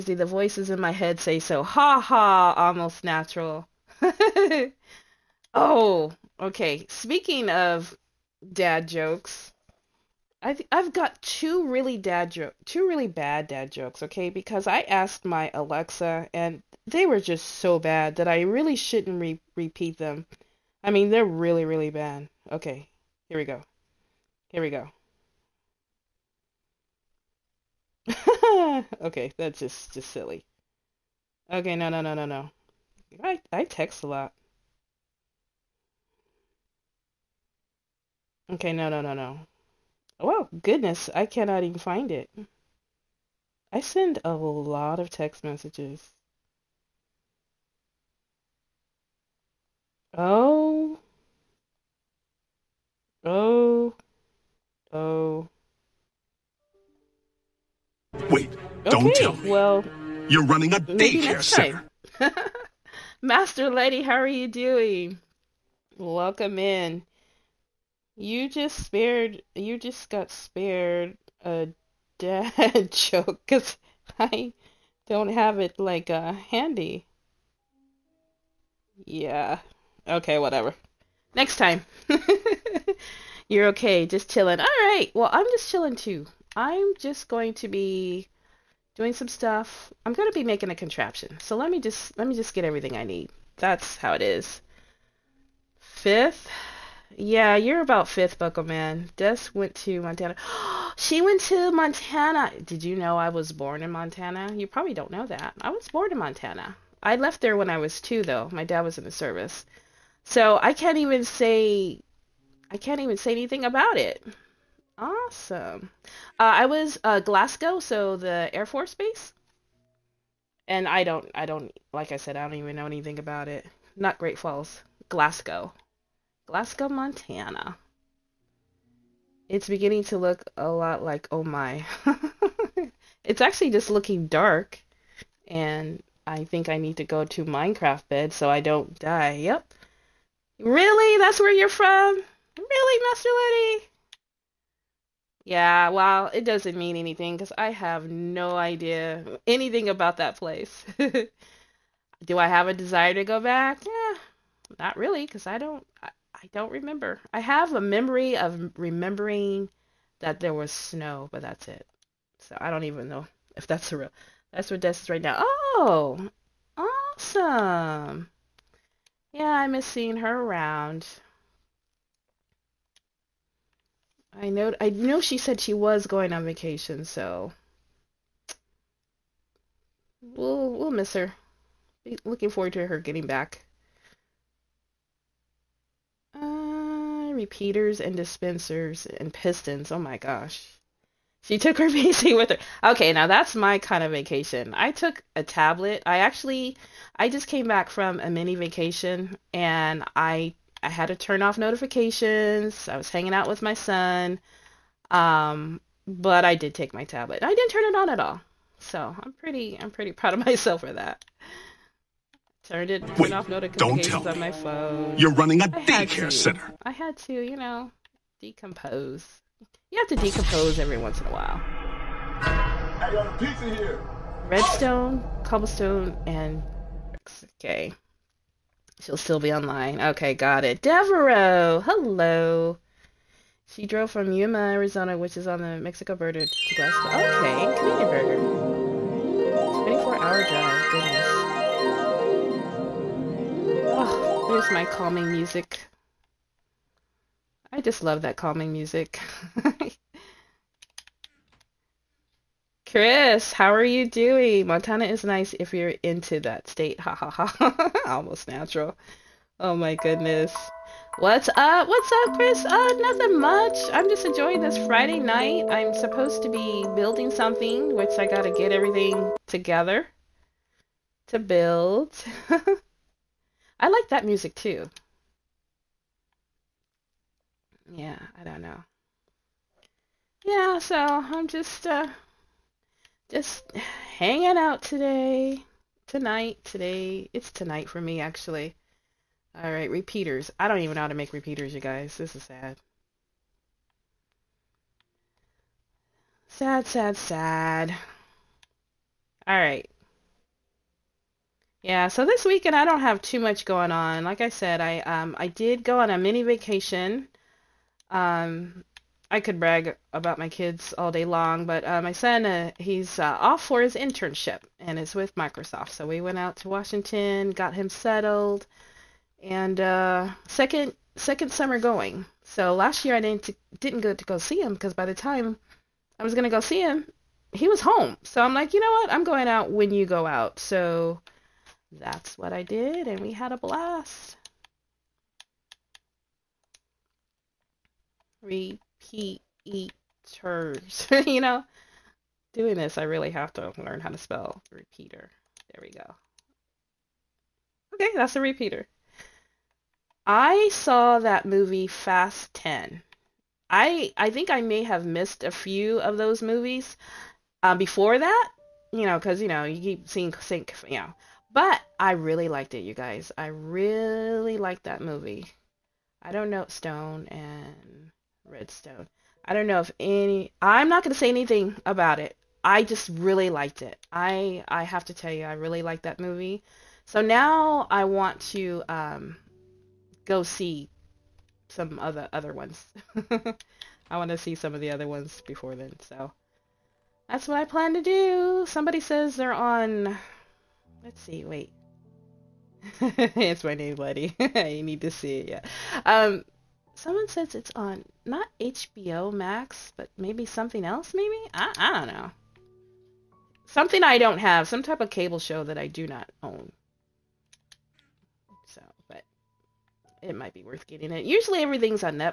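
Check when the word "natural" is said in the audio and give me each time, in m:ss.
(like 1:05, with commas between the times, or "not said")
0:03, 4:18.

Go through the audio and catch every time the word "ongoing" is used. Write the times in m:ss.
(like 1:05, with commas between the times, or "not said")
not said.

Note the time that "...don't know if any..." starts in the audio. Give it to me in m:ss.
6:09.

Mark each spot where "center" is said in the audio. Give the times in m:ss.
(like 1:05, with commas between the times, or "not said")
1:01, 3:36.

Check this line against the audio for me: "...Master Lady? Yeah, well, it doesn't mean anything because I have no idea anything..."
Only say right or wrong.
right.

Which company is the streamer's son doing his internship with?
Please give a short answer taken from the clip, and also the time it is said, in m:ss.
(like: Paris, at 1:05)
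Microsoft, at 5:15.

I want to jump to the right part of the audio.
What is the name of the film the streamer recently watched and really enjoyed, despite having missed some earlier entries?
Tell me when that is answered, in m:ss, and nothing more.
5:51.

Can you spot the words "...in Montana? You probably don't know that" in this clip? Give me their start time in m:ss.
1:43.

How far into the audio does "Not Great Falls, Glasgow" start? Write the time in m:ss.
2:03.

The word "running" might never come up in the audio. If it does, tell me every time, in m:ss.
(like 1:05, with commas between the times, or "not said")
1:00, 3:35.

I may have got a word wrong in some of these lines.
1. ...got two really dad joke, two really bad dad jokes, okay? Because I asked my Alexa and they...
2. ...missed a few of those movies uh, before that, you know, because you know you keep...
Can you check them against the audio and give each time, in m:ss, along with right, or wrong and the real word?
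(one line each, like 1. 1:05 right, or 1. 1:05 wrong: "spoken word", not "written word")
1. 0:10 right
2. 5:55 right.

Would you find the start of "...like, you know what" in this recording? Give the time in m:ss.
5:28.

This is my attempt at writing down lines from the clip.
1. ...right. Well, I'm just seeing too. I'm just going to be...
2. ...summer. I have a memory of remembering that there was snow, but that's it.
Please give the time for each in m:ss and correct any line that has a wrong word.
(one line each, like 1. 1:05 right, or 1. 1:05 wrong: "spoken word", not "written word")
1. 1:24 wrong: "chilling", not "seeing"
2. 2:36 wrong: "remember", not "summer".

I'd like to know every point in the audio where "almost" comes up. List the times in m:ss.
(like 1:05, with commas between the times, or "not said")
0:02, 4:18.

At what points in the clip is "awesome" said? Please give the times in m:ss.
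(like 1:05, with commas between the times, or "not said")
1:54, 2:46.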